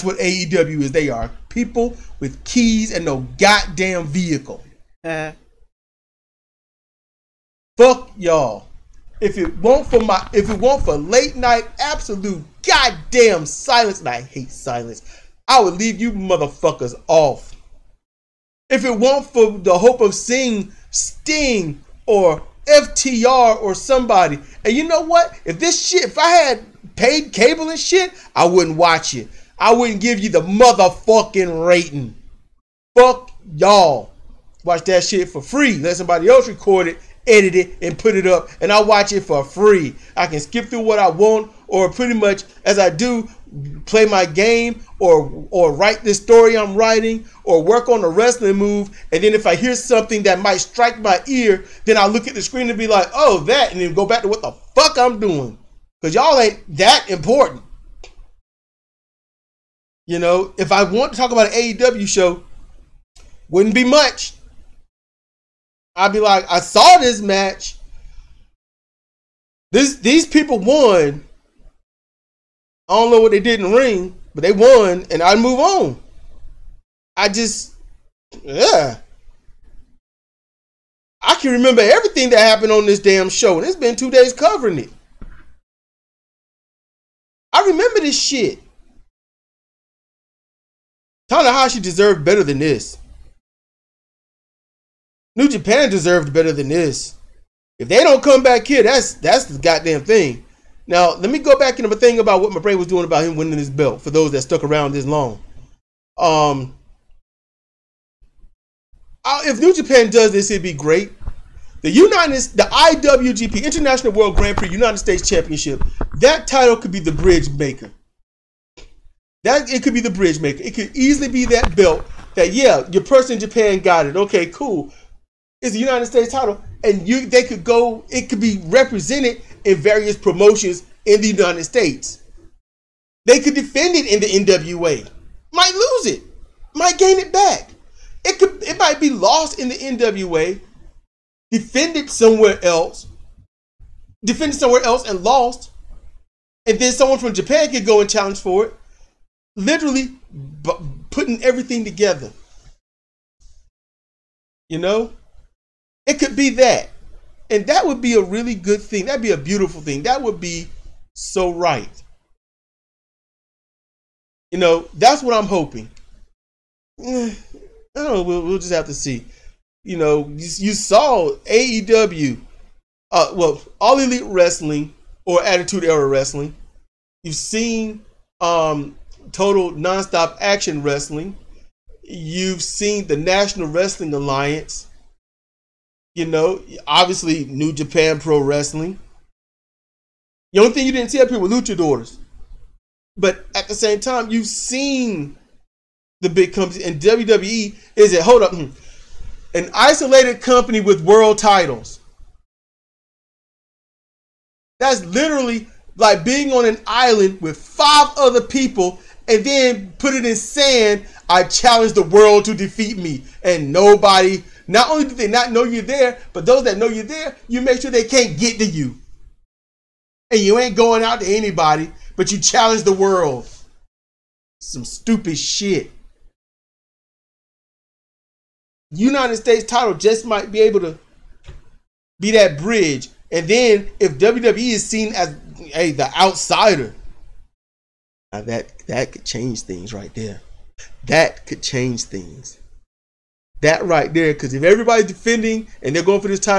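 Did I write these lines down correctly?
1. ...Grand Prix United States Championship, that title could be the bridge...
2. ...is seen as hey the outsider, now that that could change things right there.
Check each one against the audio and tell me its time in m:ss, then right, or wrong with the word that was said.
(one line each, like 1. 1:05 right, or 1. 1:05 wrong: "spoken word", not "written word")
1. 1:54 right
2. 3:54 right.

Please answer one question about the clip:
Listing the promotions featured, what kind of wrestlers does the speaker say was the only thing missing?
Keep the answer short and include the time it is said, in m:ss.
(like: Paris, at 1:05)
Luchadors, at 3:11.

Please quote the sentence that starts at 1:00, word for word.
You know, if I want to talk about an AEW show, wouldn't be much.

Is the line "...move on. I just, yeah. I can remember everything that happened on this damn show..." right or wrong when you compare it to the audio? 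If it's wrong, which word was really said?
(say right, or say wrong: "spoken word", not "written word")
right.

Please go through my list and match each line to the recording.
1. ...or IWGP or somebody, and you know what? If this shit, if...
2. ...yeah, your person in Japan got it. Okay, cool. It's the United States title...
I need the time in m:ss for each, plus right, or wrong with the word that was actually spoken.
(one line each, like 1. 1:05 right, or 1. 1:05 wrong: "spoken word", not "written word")
1. 0:22 wrong: "FTR", not "IWGP"
2. 2:02 right.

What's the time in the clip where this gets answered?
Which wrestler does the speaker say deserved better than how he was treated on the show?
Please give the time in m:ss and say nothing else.
1:31.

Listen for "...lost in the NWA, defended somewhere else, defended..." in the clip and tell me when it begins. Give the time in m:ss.
2:19.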